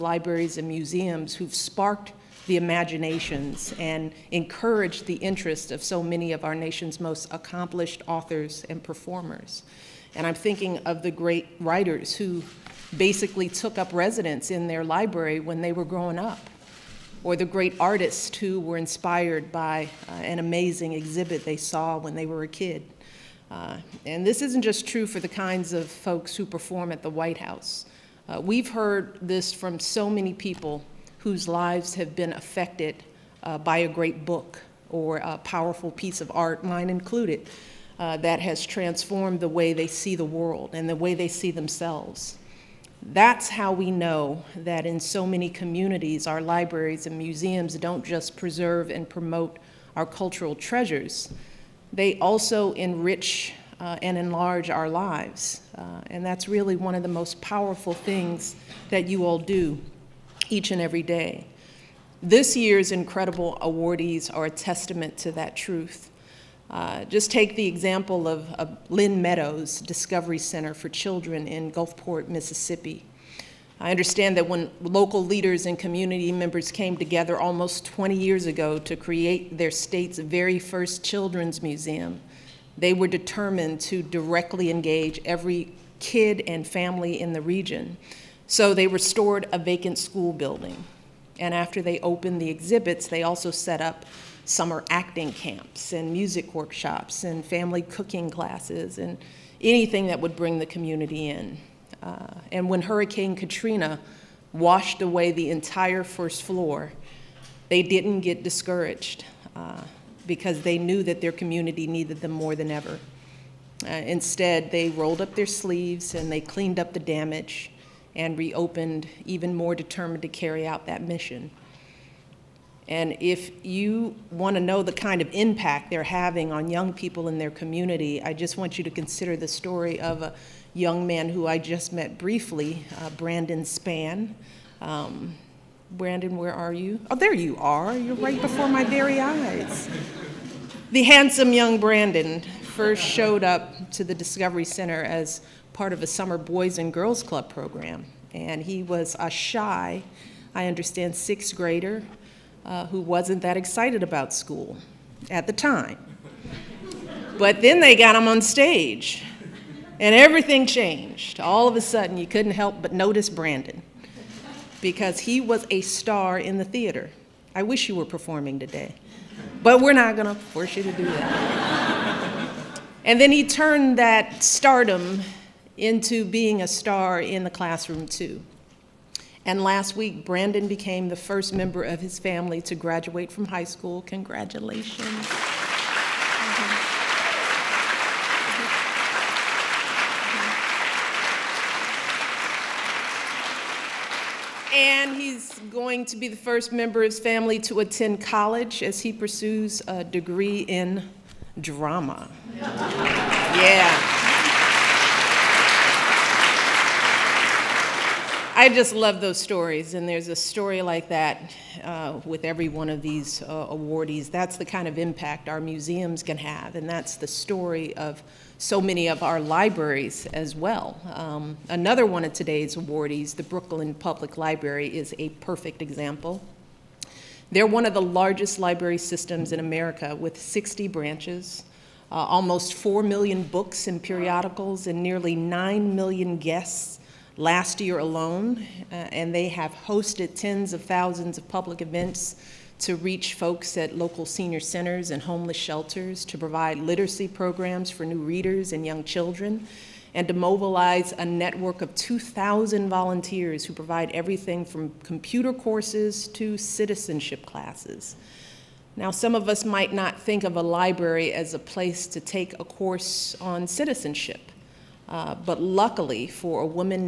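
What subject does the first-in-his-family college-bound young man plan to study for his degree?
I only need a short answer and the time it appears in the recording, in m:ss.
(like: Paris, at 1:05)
drama, at 3:21.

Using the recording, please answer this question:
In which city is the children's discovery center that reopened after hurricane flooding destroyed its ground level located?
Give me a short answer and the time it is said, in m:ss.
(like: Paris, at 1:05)
Gulfport, Mississippi, at 1:11.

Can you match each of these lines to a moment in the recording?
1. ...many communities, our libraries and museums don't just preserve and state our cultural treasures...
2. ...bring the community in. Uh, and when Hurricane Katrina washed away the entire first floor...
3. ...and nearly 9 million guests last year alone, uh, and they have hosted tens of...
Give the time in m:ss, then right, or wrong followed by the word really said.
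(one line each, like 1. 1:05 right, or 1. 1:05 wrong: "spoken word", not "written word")
1. 0:45 wrong: "promote", not "state"
2. 1:40 right
3. 3:54 right.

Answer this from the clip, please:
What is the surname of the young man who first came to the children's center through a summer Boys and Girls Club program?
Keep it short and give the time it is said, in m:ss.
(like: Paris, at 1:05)
Spann, at 2:13.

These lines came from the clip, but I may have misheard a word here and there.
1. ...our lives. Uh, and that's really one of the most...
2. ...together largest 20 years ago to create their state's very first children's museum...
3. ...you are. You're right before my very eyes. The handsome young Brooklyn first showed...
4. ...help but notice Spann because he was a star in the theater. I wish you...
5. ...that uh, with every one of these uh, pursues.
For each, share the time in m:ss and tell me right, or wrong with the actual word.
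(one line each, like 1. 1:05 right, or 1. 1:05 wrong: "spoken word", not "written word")
1. 0:54 right
2. 1:16 wrong: "almost", not "largest"
3. 2:17 wrong: "Brandon", not "Brooklyn"
4. 2:42 wrong: "Brandon", not "Spann"
5. 3:31 wrong: "awardees", not "pursues".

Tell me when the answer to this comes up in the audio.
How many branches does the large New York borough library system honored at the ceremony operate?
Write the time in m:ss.
3:50.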